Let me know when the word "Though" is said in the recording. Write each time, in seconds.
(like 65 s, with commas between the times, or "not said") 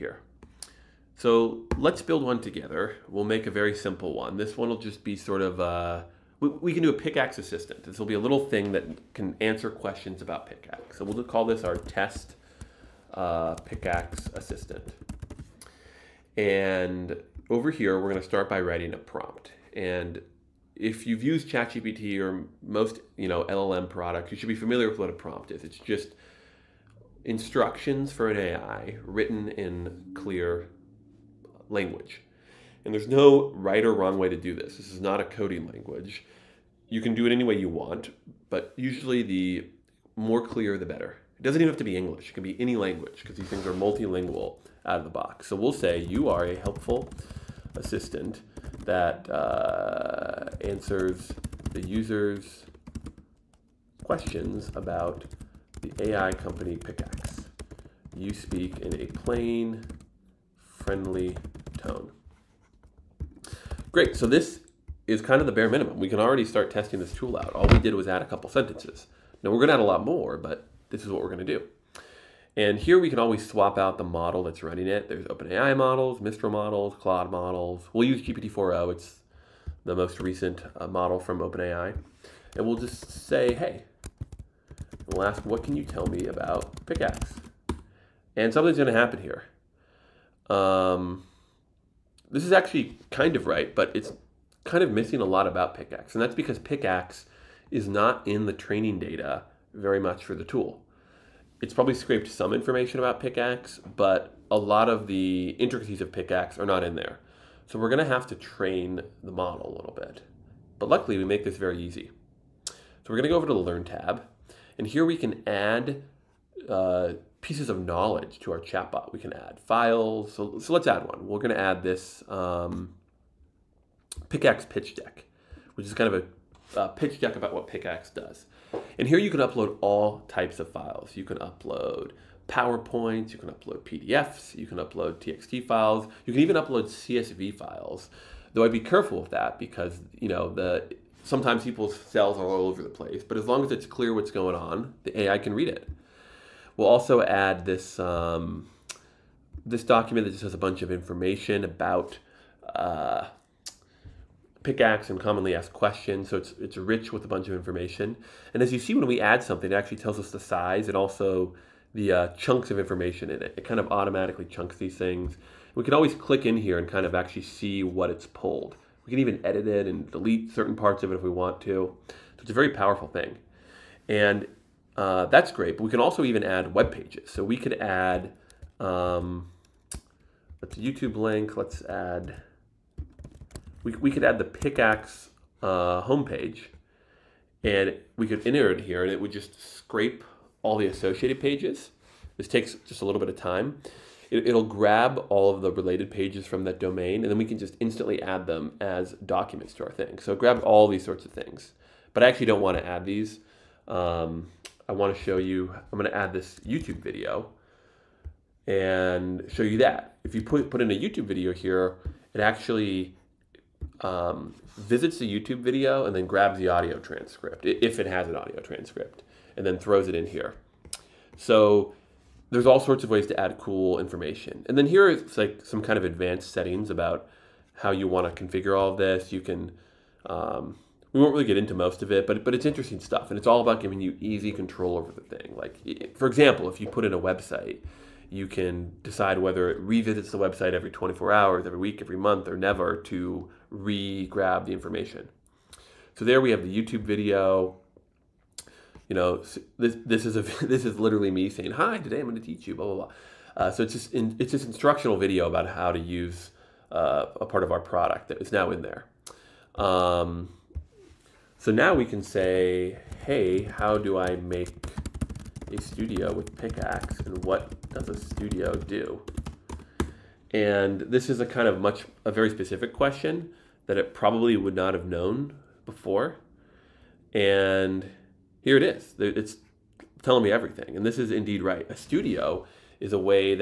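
138 s.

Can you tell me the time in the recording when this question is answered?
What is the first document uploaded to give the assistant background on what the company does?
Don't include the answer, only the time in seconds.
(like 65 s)
124 s.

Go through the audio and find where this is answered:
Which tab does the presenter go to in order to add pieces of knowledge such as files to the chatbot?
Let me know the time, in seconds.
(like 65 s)
113 s.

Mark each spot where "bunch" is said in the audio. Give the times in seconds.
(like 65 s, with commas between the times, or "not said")
150 s, 157 s.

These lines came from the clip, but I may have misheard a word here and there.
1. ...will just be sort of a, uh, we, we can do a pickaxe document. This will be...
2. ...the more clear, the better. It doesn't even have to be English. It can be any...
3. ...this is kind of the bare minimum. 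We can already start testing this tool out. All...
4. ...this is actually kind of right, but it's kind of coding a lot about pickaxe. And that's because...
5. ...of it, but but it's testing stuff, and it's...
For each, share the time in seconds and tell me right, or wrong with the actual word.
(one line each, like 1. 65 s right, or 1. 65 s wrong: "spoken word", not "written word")
1. 4 s wrong: "assistant", not "document"
2. 39 s right
3. 64 s right
4. 92 s wrong: "missing", not "coding"
5. 232 s wrong: "interesting", not "testing".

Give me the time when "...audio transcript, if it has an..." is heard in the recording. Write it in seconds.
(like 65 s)
216 s.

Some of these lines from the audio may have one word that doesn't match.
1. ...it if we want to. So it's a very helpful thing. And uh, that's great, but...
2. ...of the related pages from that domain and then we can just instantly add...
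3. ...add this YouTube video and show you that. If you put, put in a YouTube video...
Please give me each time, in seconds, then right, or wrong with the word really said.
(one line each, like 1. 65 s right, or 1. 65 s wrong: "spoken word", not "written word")
1. 171 s wrong: "powerful", not "helpful"
2. 195 s right
3. 206 s right.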